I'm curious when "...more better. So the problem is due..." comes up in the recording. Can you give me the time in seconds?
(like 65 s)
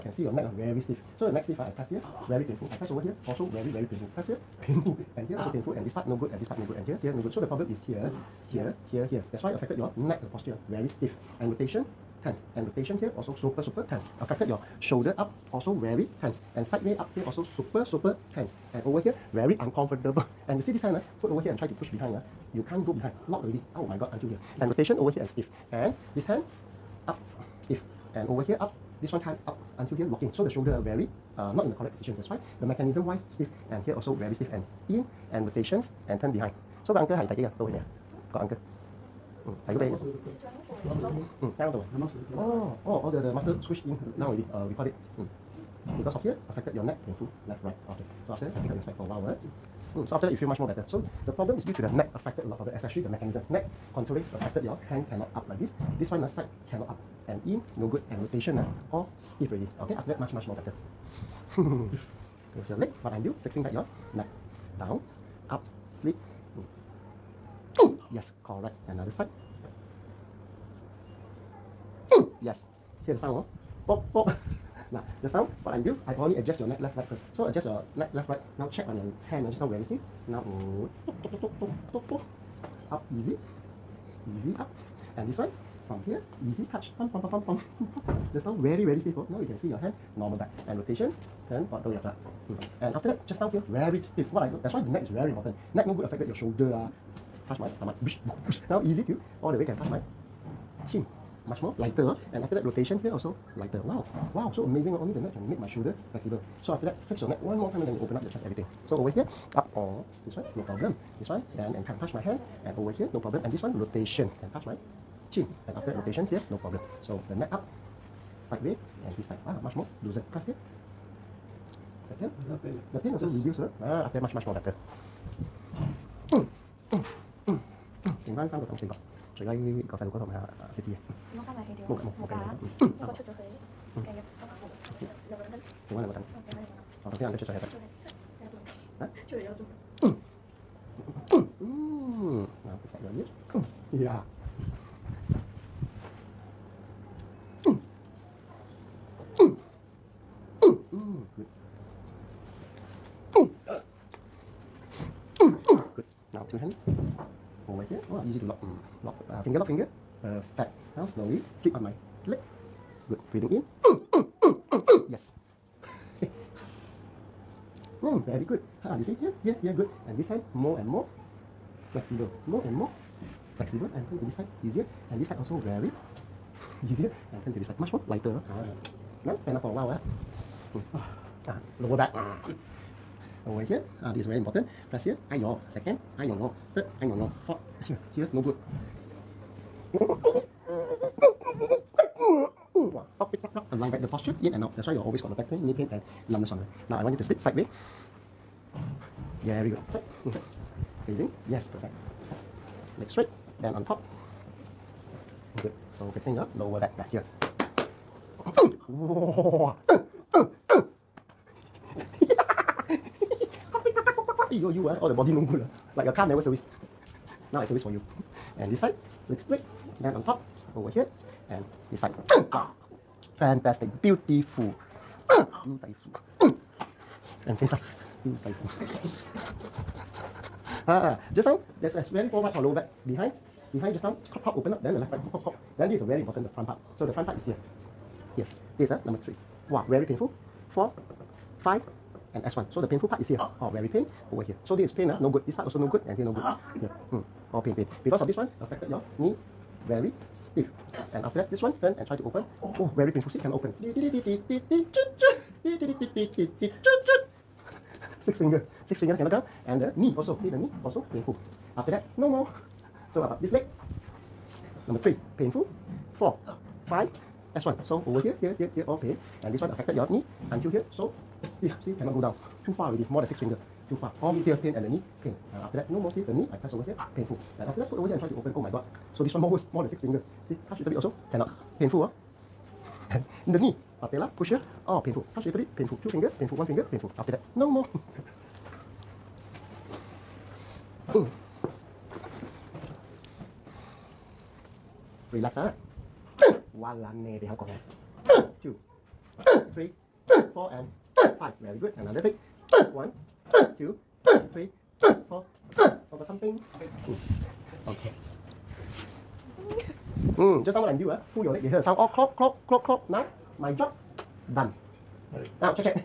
50 s.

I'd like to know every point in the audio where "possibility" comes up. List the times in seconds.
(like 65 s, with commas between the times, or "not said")
not said.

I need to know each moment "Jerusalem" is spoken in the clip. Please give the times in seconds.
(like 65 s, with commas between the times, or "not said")
not said.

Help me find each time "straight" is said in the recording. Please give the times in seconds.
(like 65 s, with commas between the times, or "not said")
203 s, 219 s.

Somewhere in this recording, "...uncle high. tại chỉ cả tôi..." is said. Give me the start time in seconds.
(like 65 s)
36 s.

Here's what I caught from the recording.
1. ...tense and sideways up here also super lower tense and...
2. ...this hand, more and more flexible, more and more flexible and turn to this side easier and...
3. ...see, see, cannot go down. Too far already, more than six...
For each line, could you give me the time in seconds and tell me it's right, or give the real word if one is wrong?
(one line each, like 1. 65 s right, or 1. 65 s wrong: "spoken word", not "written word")
1. 16 s wrong: "super", not "lower"
2. 170 s right
3. 271 s right.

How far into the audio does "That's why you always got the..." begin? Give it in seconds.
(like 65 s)
194 s.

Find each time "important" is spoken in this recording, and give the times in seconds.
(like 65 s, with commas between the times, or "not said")
95 s, 184 s, 236 s.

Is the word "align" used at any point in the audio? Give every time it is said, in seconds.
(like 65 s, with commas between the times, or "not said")
193 s.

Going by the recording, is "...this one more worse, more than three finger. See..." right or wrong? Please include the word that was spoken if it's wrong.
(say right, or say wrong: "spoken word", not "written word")
wrong: "six", not "three".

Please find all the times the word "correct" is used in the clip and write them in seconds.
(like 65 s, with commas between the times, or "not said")
31 s, 68 s.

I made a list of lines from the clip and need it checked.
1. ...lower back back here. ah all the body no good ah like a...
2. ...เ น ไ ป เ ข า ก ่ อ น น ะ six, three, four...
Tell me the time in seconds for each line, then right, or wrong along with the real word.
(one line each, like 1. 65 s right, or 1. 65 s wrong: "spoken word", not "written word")
1. 206 s right
2. 297 s wrong: "two", not "six".